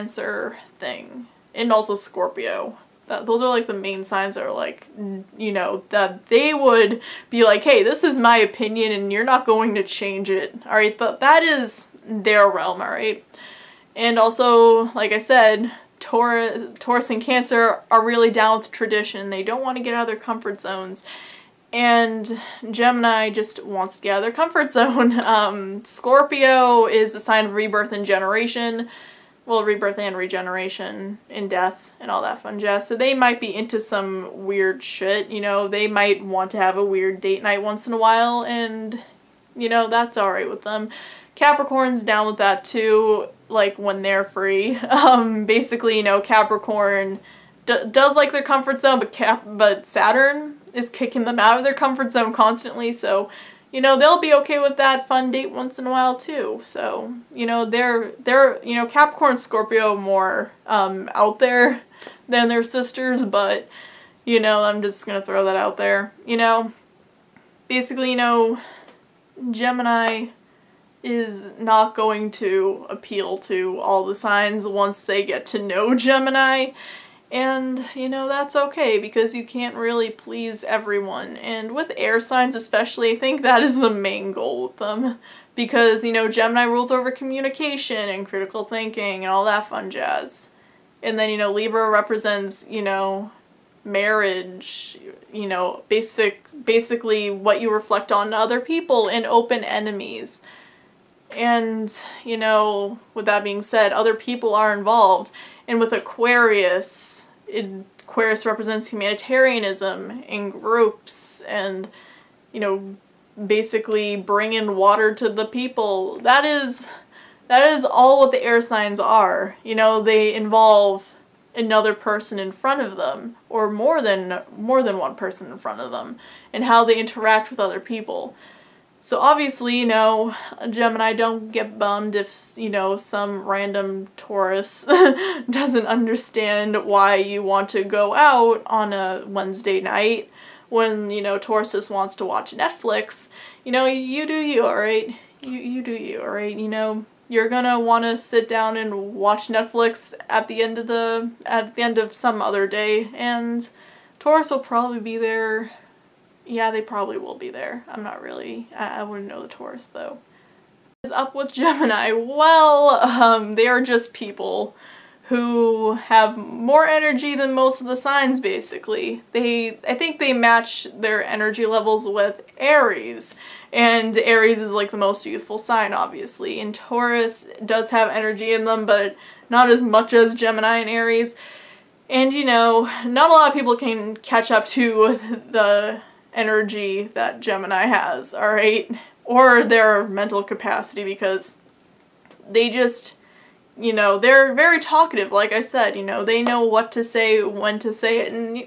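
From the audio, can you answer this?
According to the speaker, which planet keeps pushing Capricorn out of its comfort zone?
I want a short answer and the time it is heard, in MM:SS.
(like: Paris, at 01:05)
Saturn, at 00:49.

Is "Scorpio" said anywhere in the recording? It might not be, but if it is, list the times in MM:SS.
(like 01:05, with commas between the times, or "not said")
00:01, 00:25, 00:59.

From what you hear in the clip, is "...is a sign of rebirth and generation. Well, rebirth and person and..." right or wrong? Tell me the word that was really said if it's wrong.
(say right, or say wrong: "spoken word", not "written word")
wrong: "regeneration", not "person".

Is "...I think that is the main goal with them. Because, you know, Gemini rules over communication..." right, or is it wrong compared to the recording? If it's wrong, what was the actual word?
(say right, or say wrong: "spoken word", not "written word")
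right.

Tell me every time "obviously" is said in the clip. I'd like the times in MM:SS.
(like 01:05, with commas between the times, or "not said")
02:09, 02:55.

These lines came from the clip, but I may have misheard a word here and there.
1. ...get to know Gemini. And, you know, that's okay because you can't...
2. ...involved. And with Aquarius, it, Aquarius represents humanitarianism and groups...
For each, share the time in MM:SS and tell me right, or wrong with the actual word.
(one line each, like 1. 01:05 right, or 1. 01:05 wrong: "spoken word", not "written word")
1. 01:15 right
2. 01:44 right.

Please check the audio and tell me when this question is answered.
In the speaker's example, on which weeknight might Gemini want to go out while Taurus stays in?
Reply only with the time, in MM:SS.
02:19.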